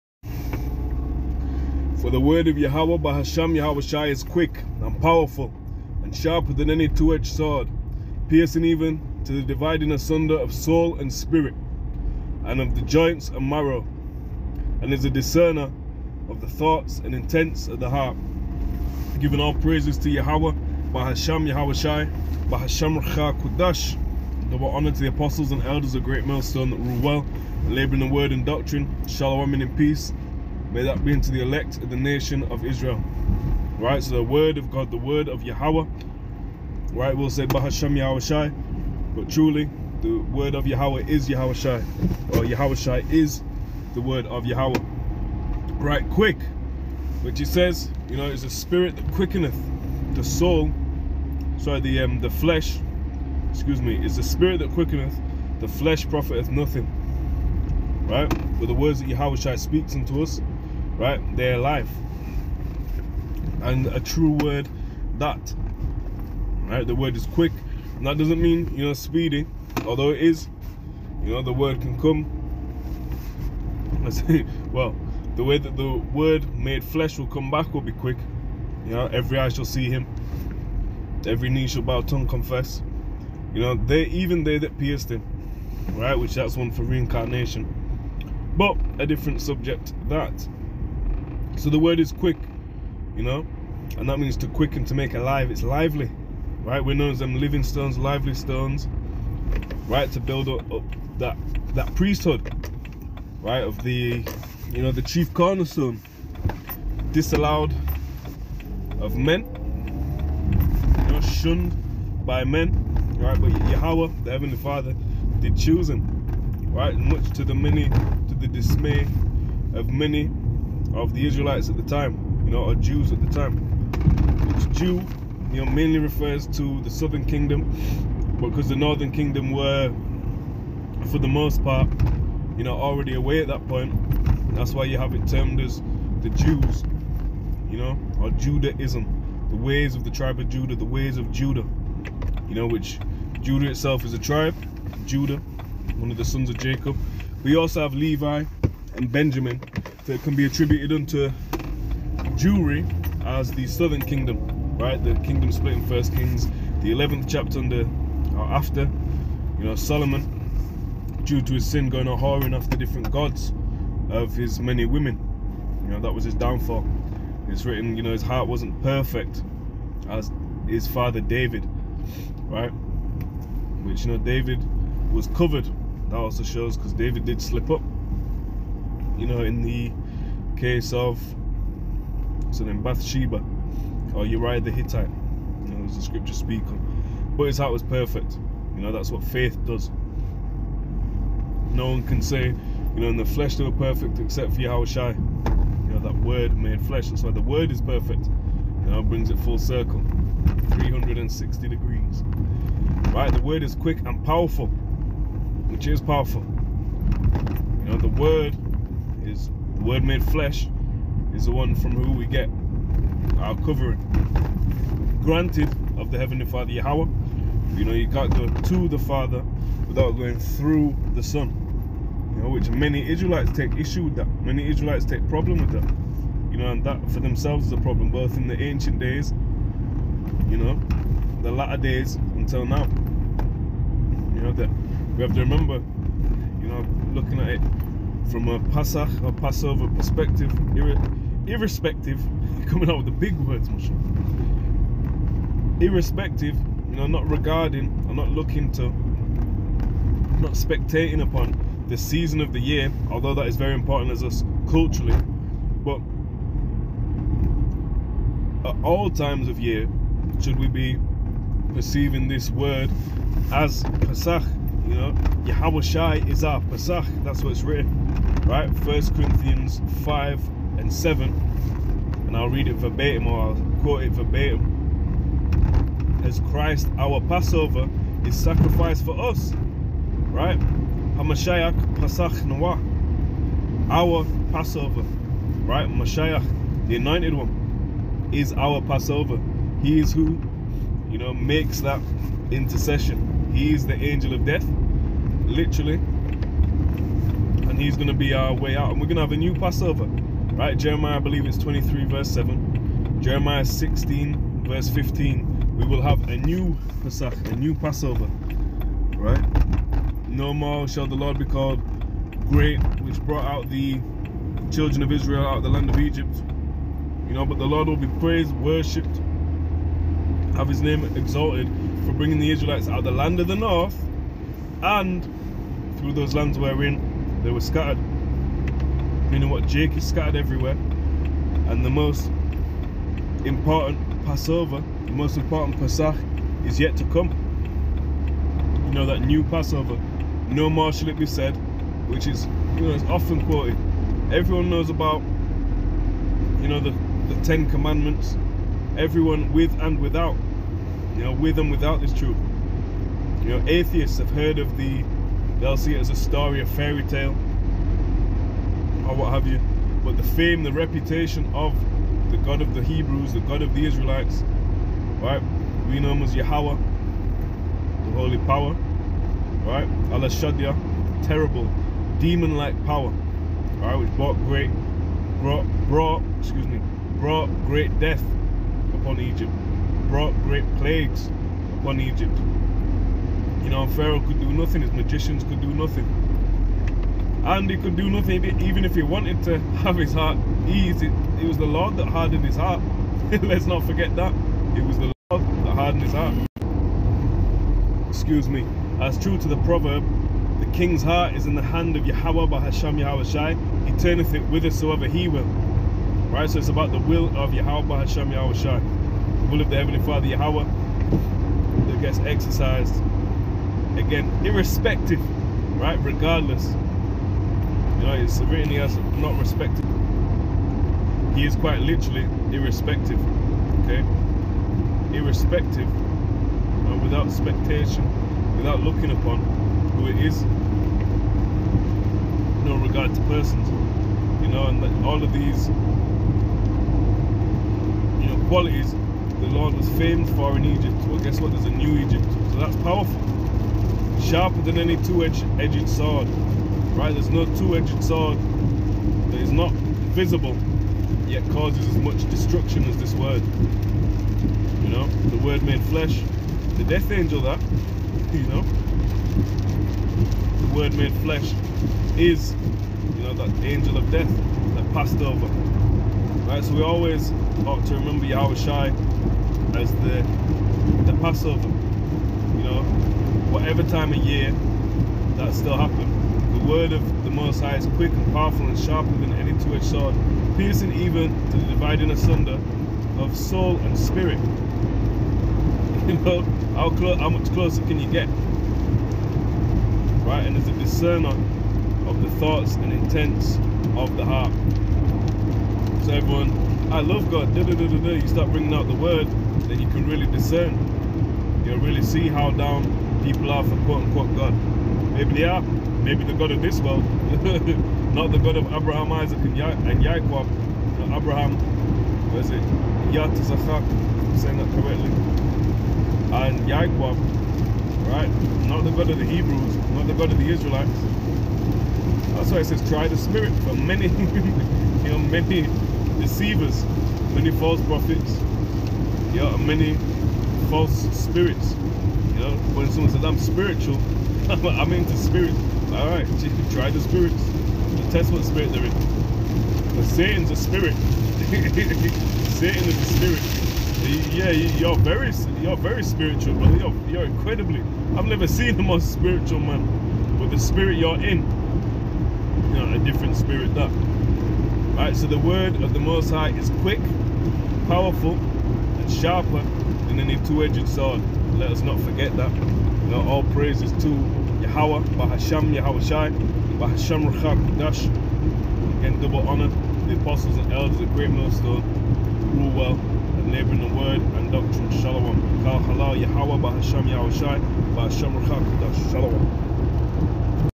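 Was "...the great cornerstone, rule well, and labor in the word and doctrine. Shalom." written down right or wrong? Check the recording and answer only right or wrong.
wrong.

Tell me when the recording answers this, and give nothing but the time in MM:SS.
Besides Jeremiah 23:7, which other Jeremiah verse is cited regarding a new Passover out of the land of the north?
05:03.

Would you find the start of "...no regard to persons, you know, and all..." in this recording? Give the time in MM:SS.
07:12.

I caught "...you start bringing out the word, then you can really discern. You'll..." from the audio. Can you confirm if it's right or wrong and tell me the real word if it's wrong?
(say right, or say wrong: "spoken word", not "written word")
right.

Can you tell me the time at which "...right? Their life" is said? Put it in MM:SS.
01:01.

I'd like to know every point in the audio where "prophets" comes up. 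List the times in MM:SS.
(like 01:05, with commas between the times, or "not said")
08:47.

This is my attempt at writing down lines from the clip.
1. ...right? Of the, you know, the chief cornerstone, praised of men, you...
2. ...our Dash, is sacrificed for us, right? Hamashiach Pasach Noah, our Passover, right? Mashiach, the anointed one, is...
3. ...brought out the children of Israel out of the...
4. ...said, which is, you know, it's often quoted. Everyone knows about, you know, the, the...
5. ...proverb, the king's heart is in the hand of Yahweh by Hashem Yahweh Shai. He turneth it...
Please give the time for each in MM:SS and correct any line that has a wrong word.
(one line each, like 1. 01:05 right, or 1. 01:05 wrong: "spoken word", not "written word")
1. 01:43 wrong: "disallowed", not "praised"
2. 04:36 wrong: "Passover", not "Dash"
3. 05:13 right
4. 05:41 right
5. 06:39 right.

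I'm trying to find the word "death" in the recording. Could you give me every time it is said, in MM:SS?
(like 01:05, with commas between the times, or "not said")
04:54, 06:17, 07:36, 07:44.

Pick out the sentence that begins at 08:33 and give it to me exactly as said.
Yat Zachak, I'm saying that correctly.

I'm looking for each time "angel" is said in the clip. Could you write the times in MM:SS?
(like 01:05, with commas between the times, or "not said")
04:53, 07:37, 07:43.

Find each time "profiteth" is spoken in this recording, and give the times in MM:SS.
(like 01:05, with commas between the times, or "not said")
00:56.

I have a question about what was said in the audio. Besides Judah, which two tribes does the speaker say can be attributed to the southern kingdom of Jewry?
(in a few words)
Levi and Benjamin.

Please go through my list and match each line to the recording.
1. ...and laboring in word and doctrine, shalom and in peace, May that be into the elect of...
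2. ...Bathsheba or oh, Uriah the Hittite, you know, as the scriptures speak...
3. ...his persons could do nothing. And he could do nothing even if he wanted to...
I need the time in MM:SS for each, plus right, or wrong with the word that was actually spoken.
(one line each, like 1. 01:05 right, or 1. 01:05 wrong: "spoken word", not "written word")
1. 00:27 right
2. 03:02 right
3. 06:24 wrong: "magicians", not "persons".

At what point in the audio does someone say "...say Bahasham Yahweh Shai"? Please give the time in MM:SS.
00:37.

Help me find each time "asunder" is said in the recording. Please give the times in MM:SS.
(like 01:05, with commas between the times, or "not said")
00:09, 08:02.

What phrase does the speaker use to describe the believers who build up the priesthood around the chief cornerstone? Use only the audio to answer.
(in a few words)
lively stones.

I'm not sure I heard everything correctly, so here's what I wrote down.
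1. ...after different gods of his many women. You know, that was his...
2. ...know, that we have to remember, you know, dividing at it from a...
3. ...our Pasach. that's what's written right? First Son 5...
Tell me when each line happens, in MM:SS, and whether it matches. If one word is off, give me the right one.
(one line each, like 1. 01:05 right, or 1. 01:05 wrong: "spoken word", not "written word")
1. 02:42 right
2. 03:54 wrong: "looking", not "dividing"
3. 04:26 wrong: "Corinthians", not "Son".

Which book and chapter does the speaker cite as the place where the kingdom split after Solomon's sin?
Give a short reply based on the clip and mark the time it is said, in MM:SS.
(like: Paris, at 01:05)
First Kings 11, at 02:35.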